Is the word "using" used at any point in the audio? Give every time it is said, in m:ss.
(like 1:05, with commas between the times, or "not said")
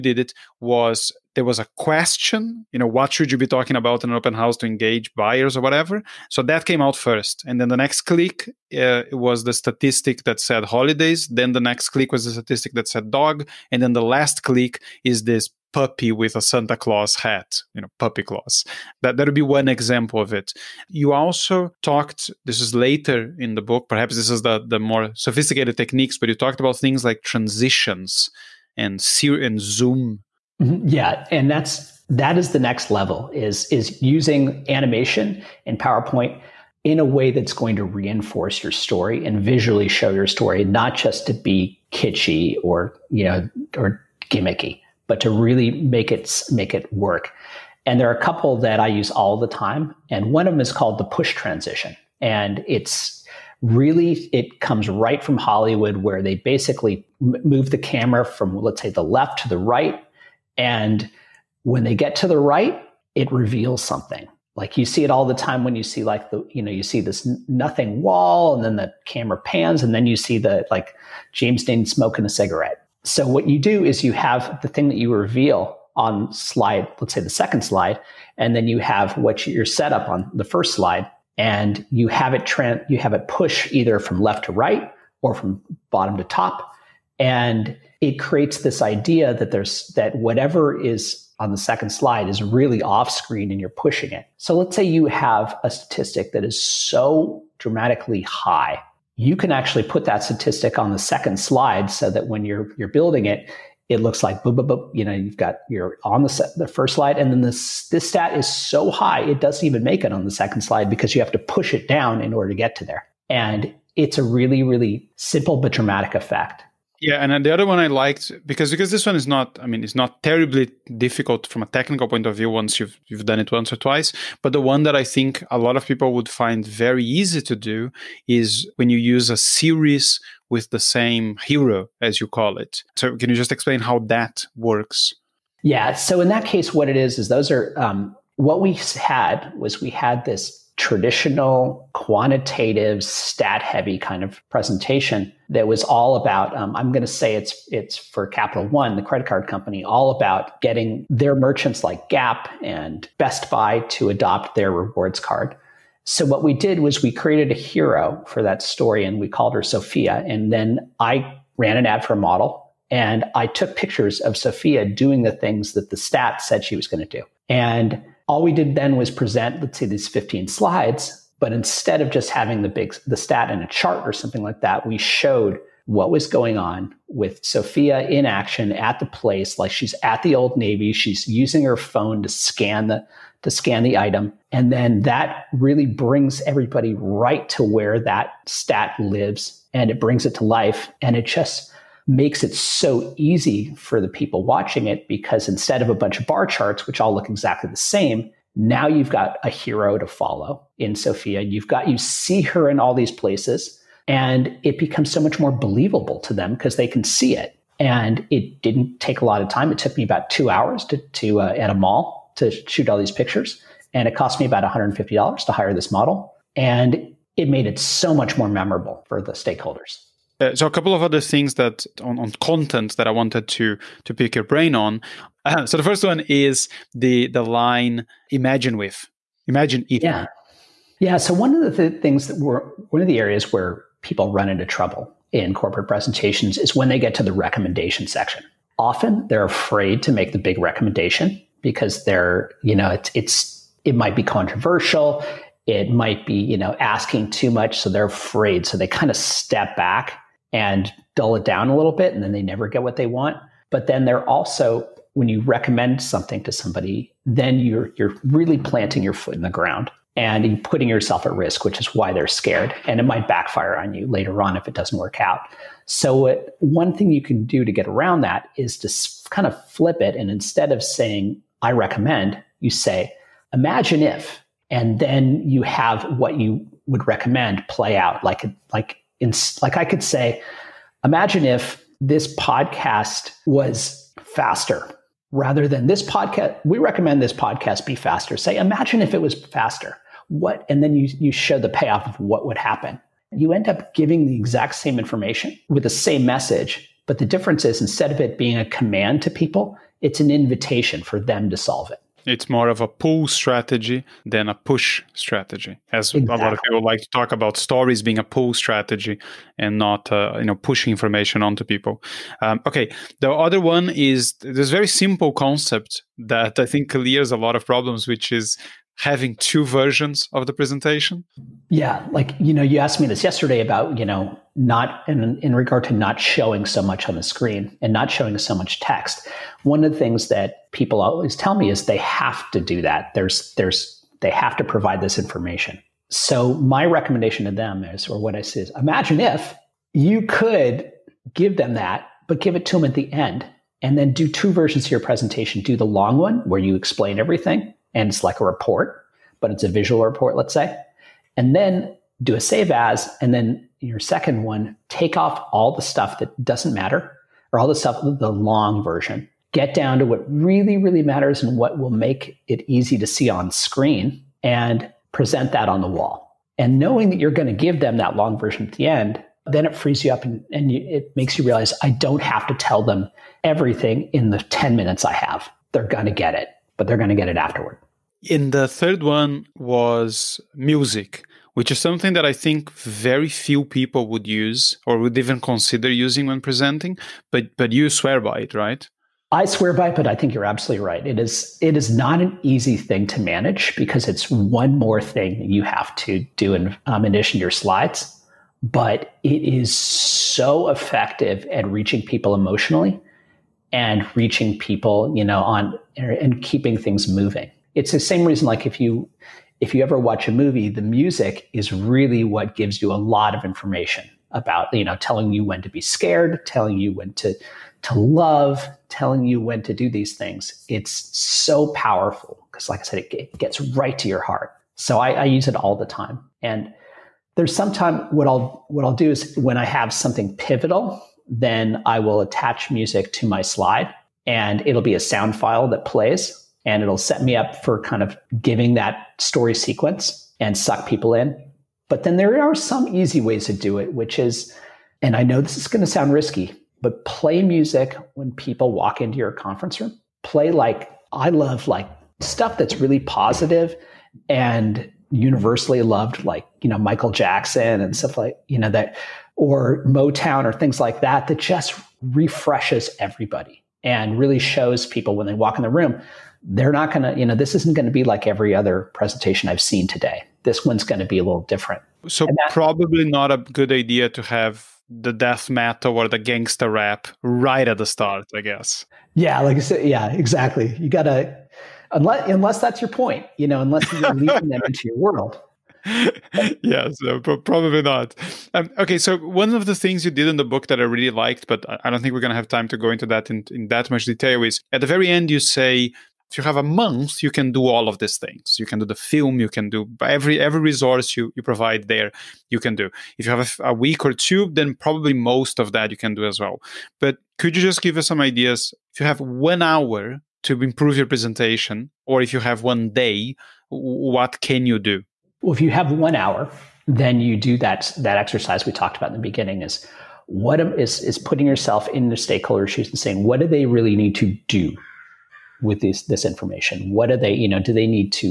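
0:34, 3:01, 6:25.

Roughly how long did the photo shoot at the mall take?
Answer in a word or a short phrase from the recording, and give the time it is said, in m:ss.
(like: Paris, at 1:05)
2 hours, at 3:30.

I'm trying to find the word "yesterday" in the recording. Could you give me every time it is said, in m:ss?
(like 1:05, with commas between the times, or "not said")
5:23.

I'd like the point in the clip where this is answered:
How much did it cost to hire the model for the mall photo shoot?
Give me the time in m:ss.
3:34.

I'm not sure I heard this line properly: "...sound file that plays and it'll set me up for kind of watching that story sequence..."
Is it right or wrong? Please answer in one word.
wrong.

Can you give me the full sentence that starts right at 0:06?
So that came out first, and then the next click uh, was the statistic that said holidays.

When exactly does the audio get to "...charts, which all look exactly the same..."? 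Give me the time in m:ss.
3:16.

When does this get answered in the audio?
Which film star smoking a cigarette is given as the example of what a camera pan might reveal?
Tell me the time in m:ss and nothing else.
1:11.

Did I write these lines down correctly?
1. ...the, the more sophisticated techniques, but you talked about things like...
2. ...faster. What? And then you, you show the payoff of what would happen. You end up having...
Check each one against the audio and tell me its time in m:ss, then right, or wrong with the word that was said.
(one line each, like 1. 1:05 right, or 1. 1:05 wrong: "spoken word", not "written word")
1. 0:24 right
2. 4:49 wrong: "giving", not "having".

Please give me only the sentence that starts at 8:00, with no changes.
You got to, unless, unless that's your point, you know, unless you're leading them into your world.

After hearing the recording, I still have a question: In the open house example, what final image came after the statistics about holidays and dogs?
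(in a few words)
puppy with a Santa Claus hat.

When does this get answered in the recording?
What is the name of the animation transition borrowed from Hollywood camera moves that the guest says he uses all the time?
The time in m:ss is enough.
0:51.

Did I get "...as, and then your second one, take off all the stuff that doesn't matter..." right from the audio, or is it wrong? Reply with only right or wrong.
right.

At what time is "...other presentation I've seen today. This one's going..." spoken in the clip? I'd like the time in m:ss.
7:48.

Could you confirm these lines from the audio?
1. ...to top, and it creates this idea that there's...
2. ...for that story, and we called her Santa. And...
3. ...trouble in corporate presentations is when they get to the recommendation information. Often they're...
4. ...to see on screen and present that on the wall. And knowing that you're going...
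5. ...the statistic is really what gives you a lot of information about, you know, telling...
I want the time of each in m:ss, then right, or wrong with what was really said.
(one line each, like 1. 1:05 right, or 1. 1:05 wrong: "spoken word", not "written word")
1. 1:26 right
2. 2:38 wrong: "Sophia", not "Santa"
3. 3:54 wrong: "section", not "information"
4. 6:02 right
5. 6:50 wrong: "music", not "statistic".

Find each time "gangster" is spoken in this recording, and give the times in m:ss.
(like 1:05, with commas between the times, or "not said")
7:56.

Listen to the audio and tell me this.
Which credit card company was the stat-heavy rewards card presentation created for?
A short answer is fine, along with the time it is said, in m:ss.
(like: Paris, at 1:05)
Capital One, at 2:28.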